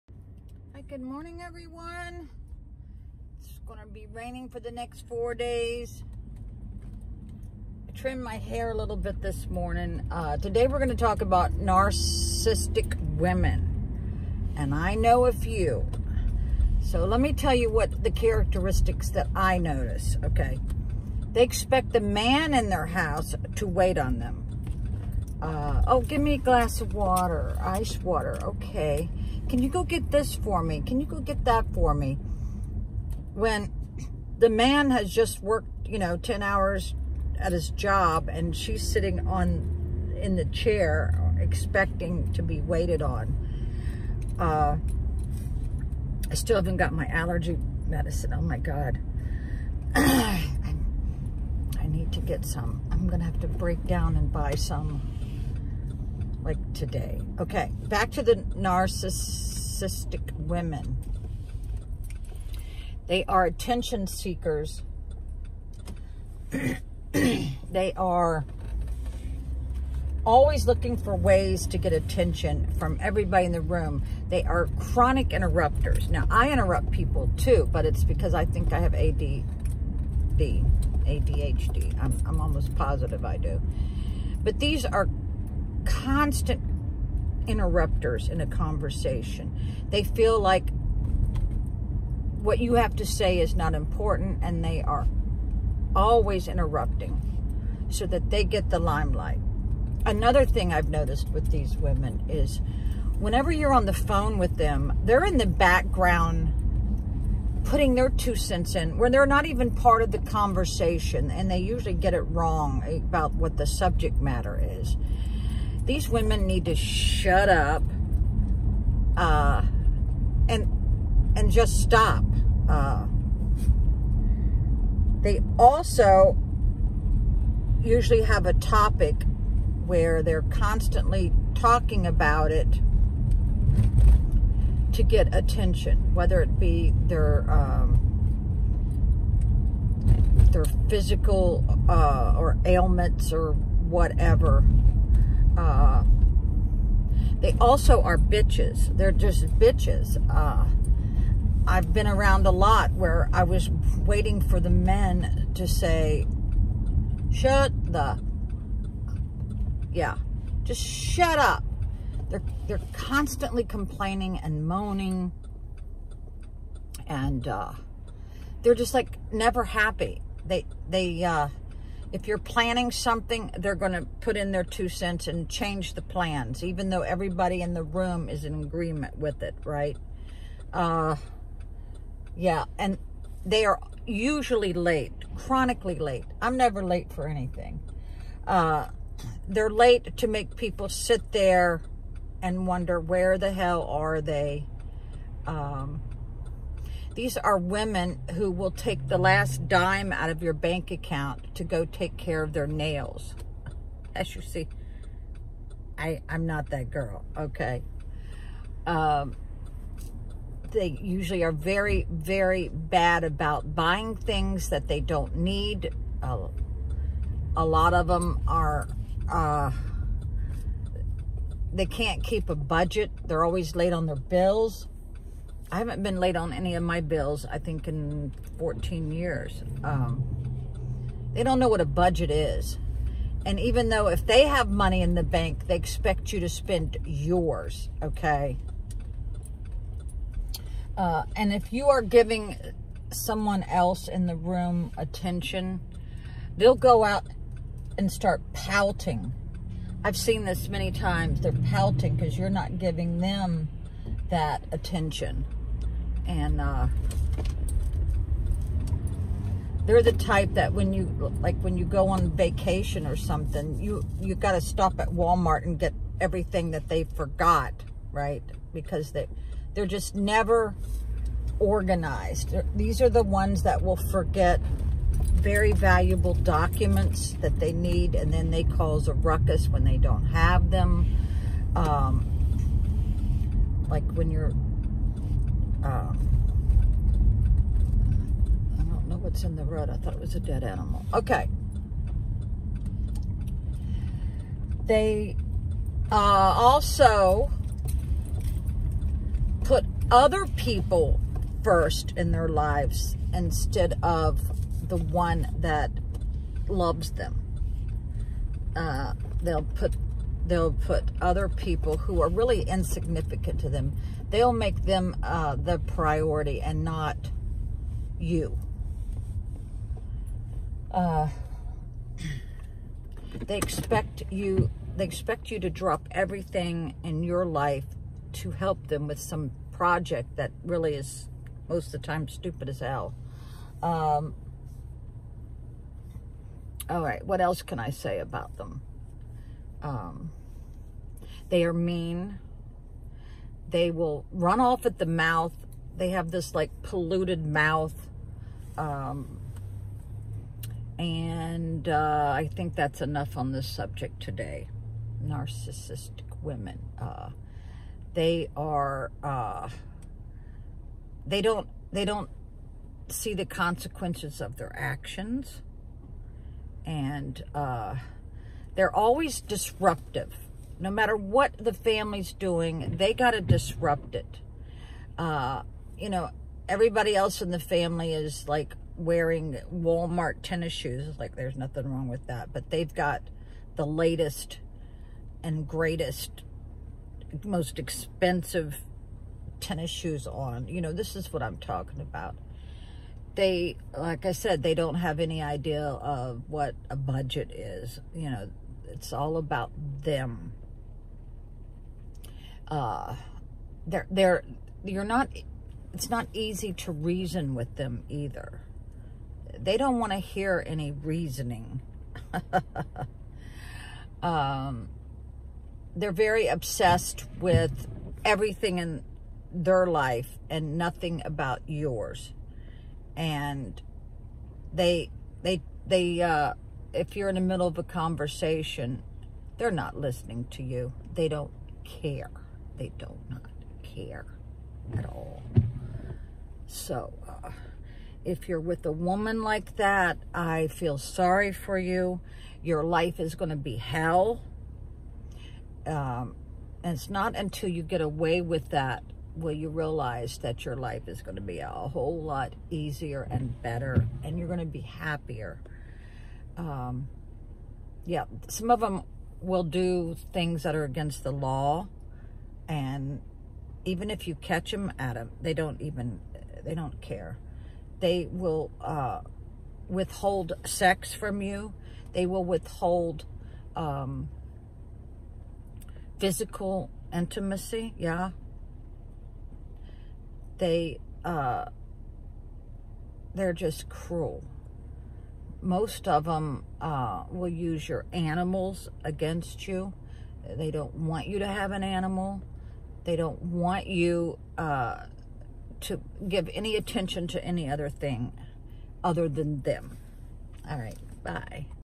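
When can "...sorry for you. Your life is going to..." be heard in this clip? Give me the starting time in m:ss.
7:20.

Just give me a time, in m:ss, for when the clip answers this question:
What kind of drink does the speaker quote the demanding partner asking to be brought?
0:27.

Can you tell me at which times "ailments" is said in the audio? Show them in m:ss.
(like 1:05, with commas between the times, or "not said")
2:22.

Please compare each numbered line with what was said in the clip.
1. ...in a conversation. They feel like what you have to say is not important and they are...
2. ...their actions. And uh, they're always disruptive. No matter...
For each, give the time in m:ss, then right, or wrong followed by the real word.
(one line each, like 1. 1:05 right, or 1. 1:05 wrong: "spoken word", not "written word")
1. 1:28 right
2. 6:04 right.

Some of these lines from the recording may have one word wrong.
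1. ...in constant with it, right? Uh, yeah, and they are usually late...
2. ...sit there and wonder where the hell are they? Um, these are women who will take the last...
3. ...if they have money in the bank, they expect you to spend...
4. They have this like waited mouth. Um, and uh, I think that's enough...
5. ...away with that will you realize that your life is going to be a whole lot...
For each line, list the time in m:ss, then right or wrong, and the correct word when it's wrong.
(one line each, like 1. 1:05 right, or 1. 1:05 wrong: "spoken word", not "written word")
1. 2:58 wrong: "agreement", not "constant"
2. 3:10 right
3. 3:54 right
4. 5:45 wrong: "polluted", not "waited"
5. 7:28 right.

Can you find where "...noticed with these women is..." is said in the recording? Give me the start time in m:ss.
1:40.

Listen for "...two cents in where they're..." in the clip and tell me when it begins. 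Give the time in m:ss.
1:48.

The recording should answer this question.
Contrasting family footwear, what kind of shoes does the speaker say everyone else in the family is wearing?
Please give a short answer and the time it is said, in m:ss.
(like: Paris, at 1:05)
Walmart tennis shoes, at 6:19.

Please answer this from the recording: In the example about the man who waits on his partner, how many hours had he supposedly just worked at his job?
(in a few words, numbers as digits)
10 hours.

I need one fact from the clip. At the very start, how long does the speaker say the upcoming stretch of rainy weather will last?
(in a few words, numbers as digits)
4 days.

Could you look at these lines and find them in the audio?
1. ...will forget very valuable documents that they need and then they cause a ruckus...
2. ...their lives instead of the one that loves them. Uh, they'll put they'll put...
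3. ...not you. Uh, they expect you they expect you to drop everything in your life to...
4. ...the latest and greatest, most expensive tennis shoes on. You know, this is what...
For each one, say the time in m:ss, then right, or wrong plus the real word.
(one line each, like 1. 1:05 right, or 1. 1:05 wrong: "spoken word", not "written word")
1. 4:33 right
2. 5:02 right
3. 5:16 right
4. 6:23 right.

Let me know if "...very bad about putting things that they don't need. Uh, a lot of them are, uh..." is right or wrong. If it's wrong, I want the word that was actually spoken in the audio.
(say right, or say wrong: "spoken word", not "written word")
wrong: "buying", not "putting".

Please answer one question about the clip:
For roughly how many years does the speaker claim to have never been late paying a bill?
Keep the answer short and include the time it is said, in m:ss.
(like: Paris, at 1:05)
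14 years, at 3:48.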